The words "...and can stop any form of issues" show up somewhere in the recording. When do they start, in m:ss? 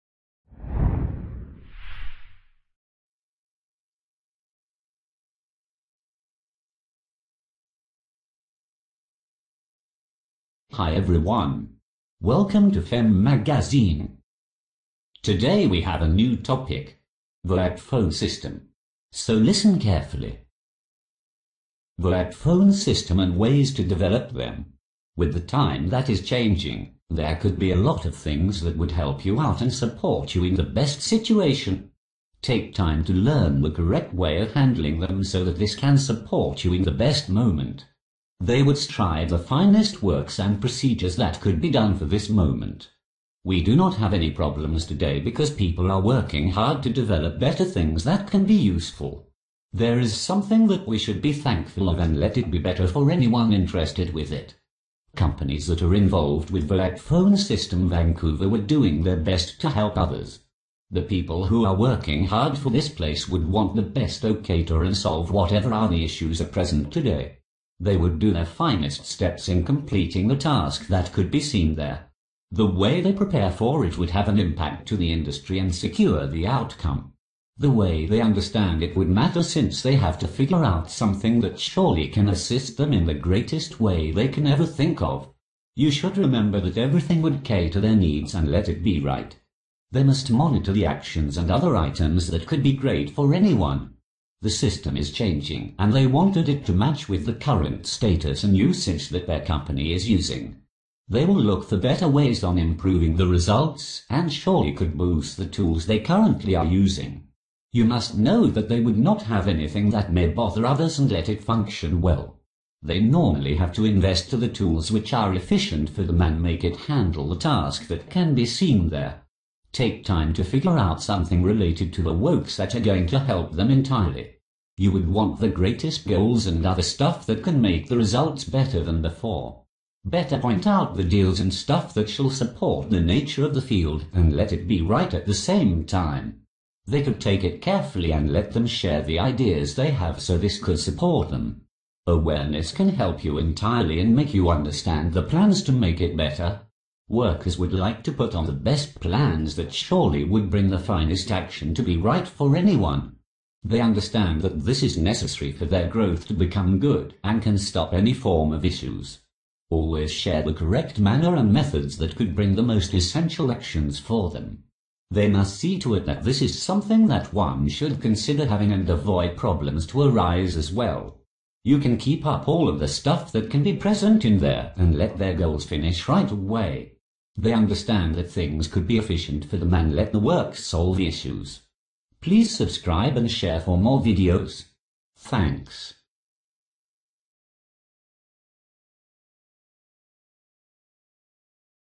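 2:37.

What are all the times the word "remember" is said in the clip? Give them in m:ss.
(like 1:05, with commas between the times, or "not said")
1:26.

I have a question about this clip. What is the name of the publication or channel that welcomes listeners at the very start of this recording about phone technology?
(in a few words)
Femme Magazine.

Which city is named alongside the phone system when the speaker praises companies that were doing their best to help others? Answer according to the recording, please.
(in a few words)
Vancouver.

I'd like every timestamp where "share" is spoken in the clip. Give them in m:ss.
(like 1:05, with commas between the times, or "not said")
2:18, 2:40, 3:03.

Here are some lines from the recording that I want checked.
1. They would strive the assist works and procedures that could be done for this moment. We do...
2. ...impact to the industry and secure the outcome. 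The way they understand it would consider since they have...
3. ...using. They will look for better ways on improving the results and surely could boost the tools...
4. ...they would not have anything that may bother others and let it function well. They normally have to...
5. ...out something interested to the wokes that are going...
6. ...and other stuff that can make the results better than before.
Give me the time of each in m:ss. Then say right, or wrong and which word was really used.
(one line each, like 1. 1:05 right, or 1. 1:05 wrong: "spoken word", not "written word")
1. 0:38 wrong: "finest", not "assist"
2. 1:14 wrong: "matter", not "consider"
3. 1:40 right
4. 1:48 right
5. 2:00 wrong: "related", not "interested"
6. 2:06 right.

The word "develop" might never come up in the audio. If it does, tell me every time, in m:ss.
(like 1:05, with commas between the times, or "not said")
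0:23, 0:46.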